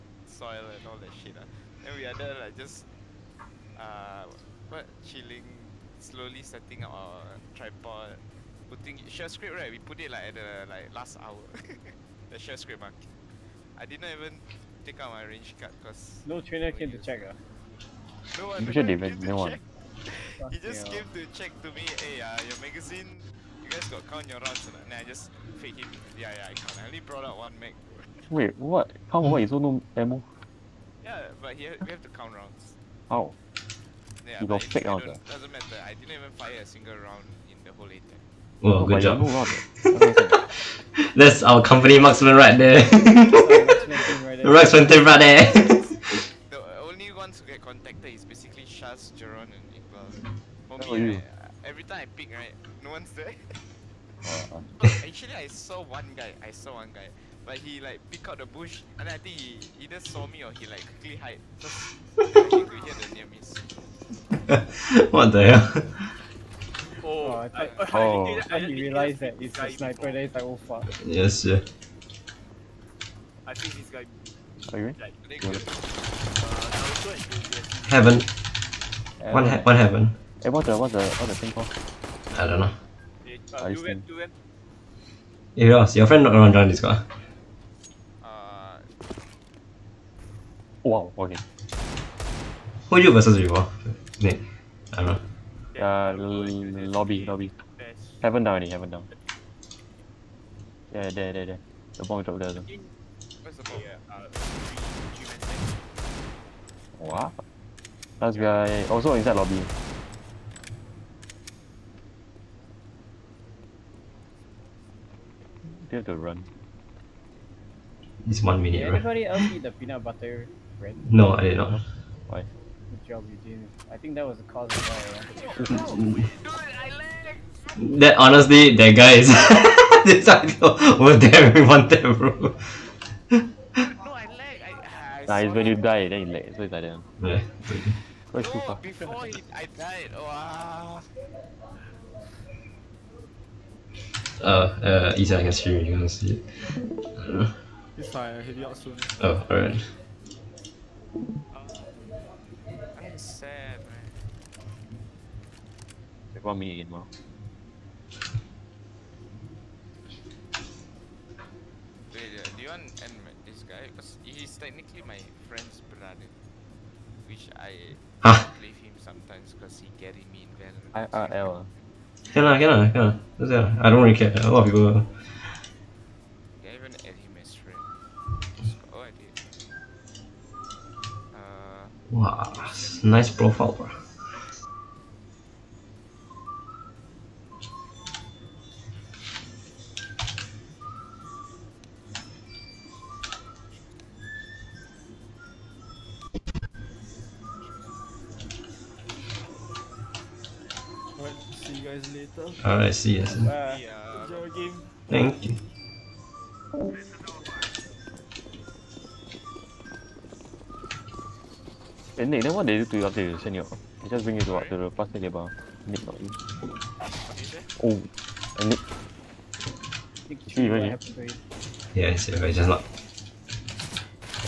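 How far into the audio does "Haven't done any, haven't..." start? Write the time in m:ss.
1:38.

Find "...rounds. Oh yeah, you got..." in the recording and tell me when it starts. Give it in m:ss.
0:32.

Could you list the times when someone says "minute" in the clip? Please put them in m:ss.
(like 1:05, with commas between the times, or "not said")
1:58.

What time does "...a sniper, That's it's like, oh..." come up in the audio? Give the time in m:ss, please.
1:09.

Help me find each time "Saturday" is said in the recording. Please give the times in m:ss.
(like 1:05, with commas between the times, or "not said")
not said.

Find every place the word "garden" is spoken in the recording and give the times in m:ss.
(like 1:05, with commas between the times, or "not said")
not said.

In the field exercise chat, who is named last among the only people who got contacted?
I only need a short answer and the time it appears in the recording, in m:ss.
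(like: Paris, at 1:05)
Iqbal, at 0:50.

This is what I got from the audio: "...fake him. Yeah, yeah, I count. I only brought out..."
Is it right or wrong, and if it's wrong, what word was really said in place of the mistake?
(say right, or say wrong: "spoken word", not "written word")
right.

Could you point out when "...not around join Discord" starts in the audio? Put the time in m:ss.
1:26.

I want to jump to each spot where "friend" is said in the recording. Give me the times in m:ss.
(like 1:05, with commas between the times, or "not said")
1:26, 2:45.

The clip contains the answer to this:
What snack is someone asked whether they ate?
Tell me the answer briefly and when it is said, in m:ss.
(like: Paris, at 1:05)
Peanut butter bread, at 1:59.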